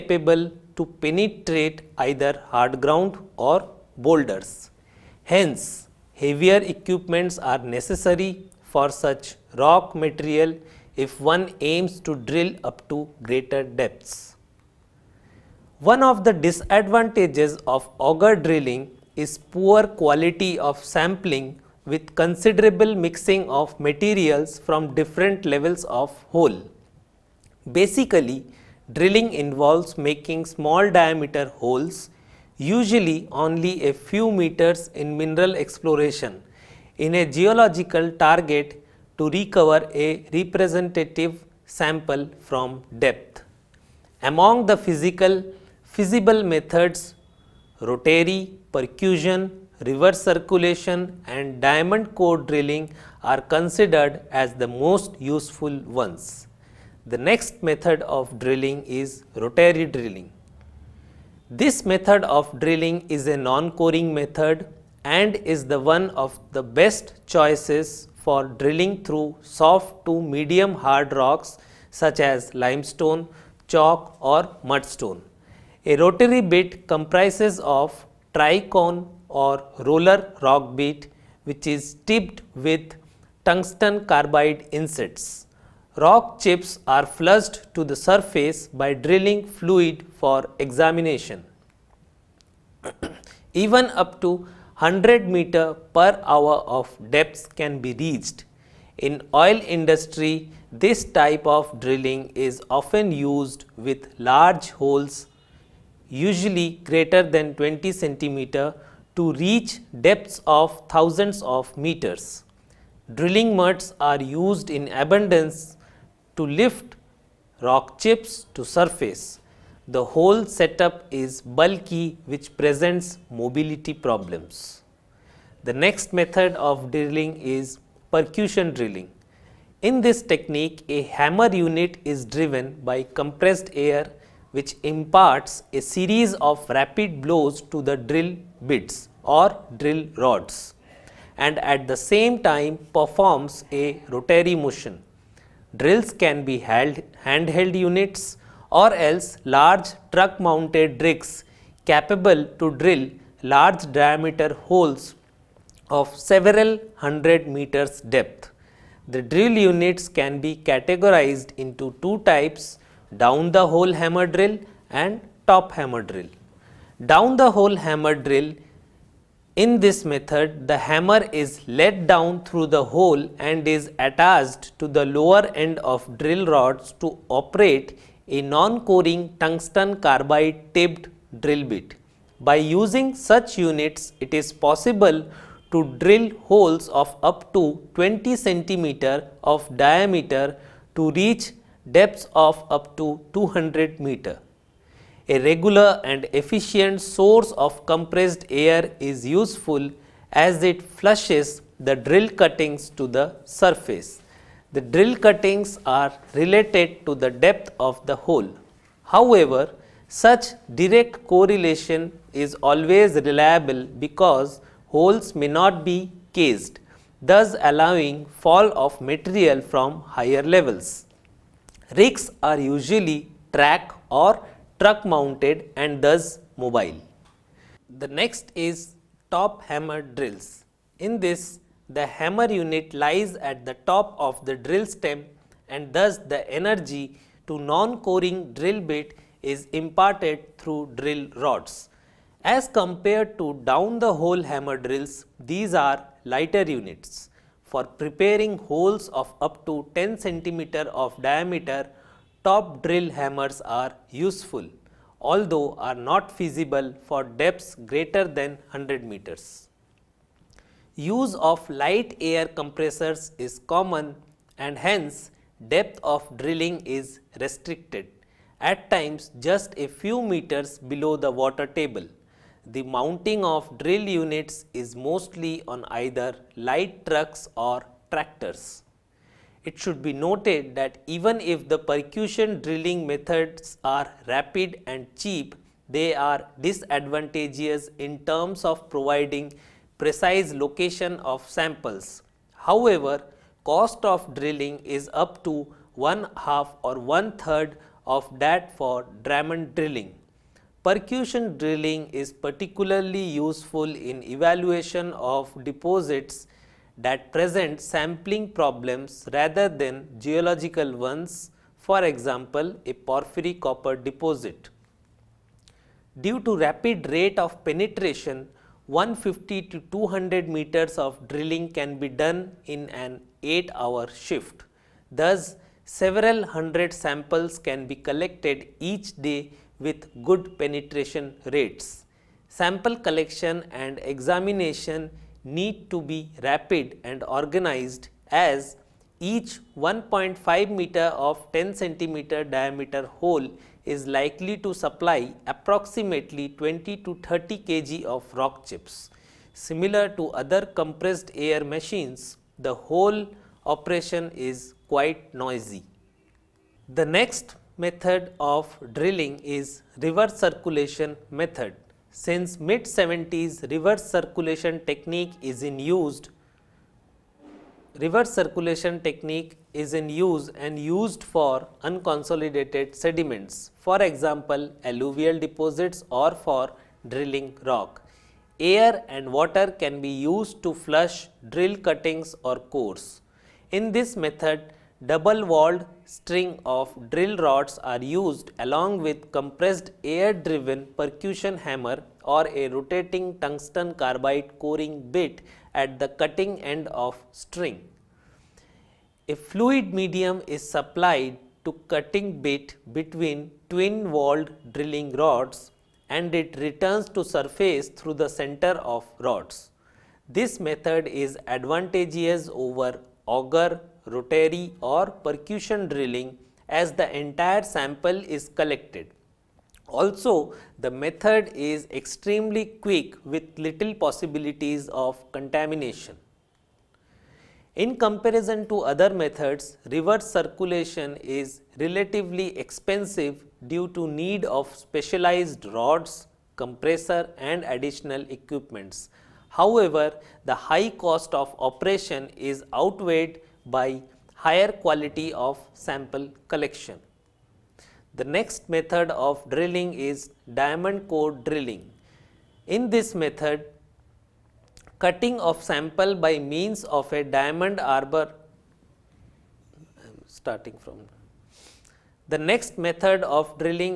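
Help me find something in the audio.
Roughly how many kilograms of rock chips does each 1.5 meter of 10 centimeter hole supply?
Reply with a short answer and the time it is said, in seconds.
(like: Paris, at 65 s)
20 to 30 kg, at 346 s.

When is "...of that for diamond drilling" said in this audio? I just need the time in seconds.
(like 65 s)
298 s.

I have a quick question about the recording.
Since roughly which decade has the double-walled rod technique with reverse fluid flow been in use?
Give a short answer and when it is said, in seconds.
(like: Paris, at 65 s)
mid 70s, at 362 s.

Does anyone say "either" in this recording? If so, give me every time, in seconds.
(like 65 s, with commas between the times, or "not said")
1 s, 275 s.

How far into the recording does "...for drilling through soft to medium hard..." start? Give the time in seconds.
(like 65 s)
68 s.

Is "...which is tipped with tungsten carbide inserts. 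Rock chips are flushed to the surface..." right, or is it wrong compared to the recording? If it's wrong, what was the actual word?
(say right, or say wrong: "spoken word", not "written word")
right.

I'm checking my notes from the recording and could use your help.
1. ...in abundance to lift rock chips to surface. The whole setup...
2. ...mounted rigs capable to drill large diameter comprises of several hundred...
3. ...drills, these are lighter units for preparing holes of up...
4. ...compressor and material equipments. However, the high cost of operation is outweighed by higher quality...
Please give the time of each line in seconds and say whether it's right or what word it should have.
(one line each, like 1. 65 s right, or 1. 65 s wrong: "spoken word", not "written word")
1. 114 s right
2. 150 s wrong: "holes", not "comprises"
3. 244 s right
4. 436 s wrong: "additional", not "material".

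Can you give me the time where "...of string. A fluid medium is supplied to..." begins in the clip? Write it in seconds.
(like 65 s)
397 s.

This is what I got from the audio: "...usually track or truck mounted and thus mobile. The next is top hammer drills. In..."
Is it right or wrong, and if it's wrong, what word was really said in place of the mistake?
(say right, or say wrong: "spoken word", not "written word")
right.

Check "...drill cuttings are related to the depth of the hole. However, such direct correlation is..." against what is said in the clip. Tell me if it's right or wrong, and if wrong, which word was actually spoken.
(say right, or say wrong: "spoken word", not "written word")
right.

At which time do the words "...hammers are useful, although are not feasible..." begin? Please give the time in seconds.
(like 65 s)
253 s.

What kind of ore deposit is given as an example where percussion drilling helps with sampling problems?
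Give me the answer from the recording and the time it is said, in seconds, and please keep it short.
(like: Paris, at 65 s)
porphyry copper deposit, at 312 s.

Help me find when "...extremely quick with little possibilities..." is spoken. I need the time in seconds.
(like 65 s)
421 s.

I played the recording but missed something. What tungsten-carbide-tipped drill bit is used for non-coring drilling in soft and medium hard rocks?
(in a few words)
tricone or roller rock bit.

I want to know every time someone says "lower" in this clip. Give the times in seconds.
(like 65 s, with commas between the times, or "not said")
175 s.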